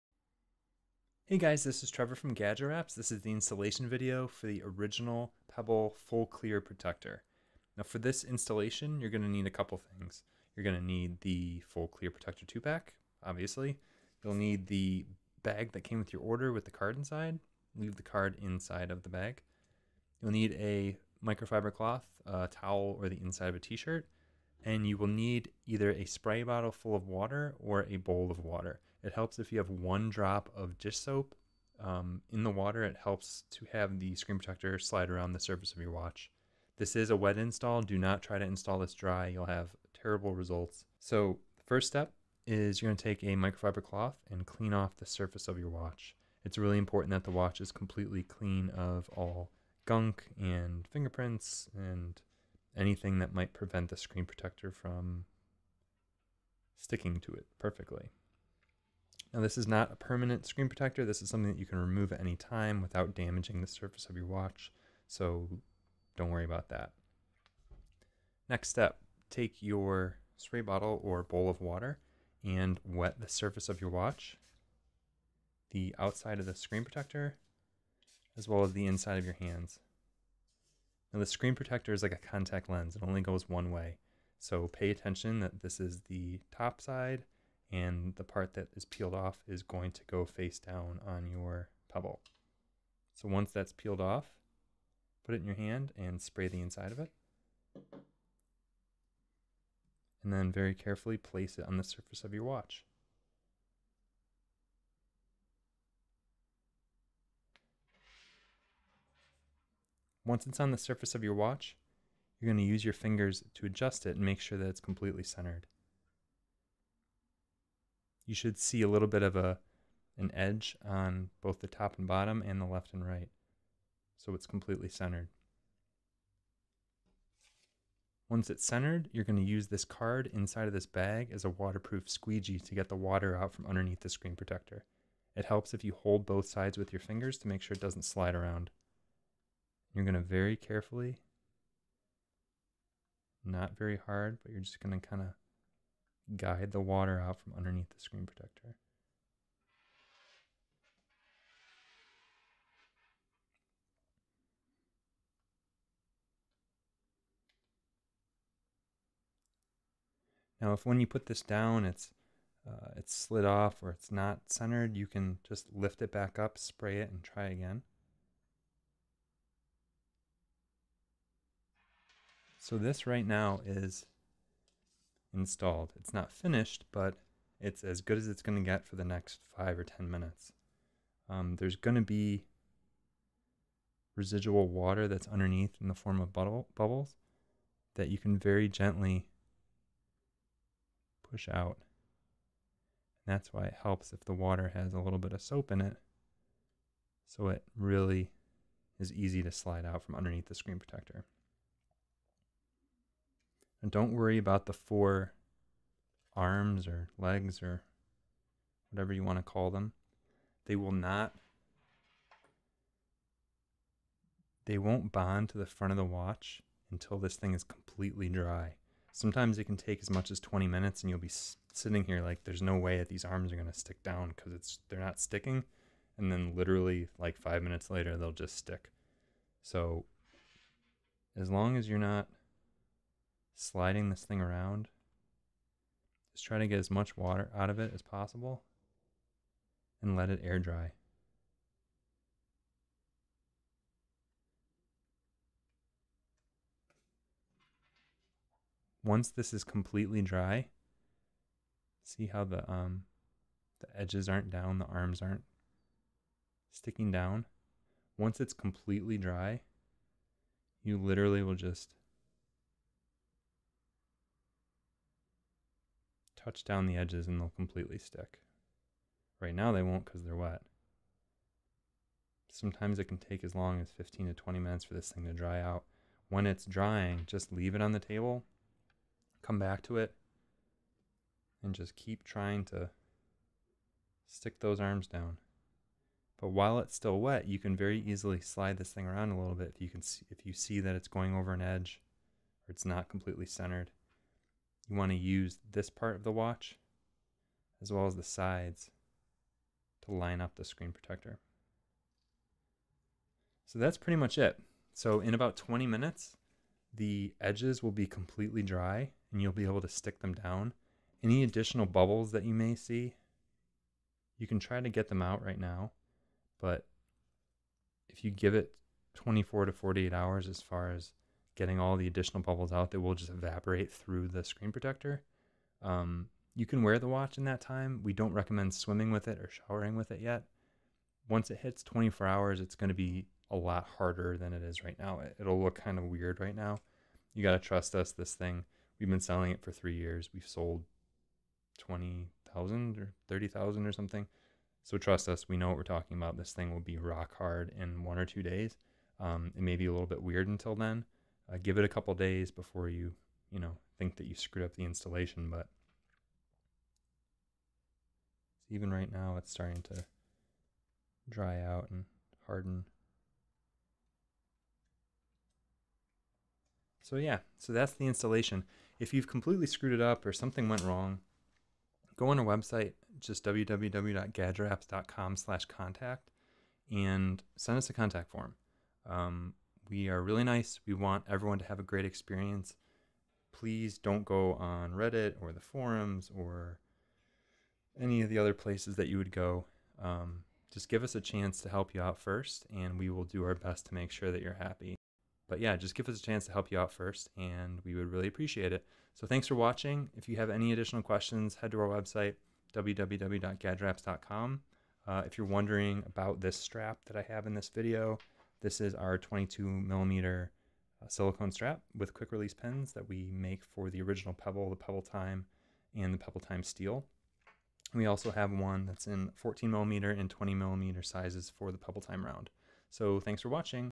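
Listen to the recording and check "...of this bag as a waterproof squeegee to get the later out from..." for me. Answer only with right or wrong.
wrong.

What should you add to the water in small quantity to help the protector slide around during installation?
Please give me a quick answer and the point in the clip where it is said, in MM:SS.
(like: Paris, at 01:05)
One drop of dish soap, at 00:29.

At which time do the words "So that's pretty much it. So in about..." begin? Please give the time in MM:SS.
05:03.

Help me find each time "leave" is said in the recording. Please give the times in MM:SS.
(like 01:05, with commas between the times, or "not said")
00:17, 04:37.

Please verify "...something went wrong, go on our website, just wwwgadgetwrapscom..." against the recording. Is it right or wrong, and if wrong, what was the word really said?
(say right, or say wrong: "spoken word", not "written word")
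right.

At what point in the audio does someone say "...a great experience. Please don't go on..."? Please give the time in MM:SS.
06:21.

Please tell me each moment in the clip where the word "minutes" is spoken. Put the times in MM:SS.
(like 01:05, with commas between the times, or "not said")
03:00, 03:40, 03:47, 04:34, 05:05.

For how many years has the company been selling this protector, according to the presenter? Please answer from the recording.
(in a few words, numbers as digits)
3 years.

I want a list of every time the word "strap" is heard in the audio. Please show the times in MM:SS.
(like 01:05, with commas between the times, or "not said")
06:46, 06:51.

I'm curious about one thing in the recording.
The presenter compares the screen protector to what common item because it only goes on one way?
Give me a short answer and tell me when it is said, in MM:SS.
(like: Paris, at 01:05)
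Contact lens, at 01:22.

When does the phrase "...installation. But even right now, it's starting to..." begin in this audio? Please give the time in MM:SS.
05:54.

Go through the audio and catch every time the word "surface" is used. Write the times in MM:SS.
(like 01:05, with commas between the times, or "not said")
00:35, 00:45, 01:03, 01:13, 01:41, 01:50.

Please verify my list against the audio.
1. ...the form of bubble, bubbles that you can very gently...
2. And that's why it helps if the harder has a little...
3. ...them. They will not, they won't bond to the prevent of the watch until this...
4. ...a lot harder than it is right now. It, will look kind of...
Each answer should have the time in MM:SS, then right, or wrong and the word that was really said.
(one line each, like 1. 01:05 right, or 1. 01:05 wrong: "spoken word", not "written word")
1. 03:05 right
2. 03:13 wrong: "water", not "harder"
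3. 03:29 wrong: "front", not "prevent"
4. 05:33 right.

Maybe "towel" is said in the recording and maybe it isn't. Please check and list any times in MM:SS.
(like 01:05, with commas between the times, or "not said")
00:22.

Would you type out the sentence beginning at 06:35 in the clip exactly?
But yeah, just give us a chance to help you out first, and we would really appreciate it.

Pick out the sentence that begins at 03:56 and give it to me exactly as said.
Just try to get as much water out of it as possible and let it air dry.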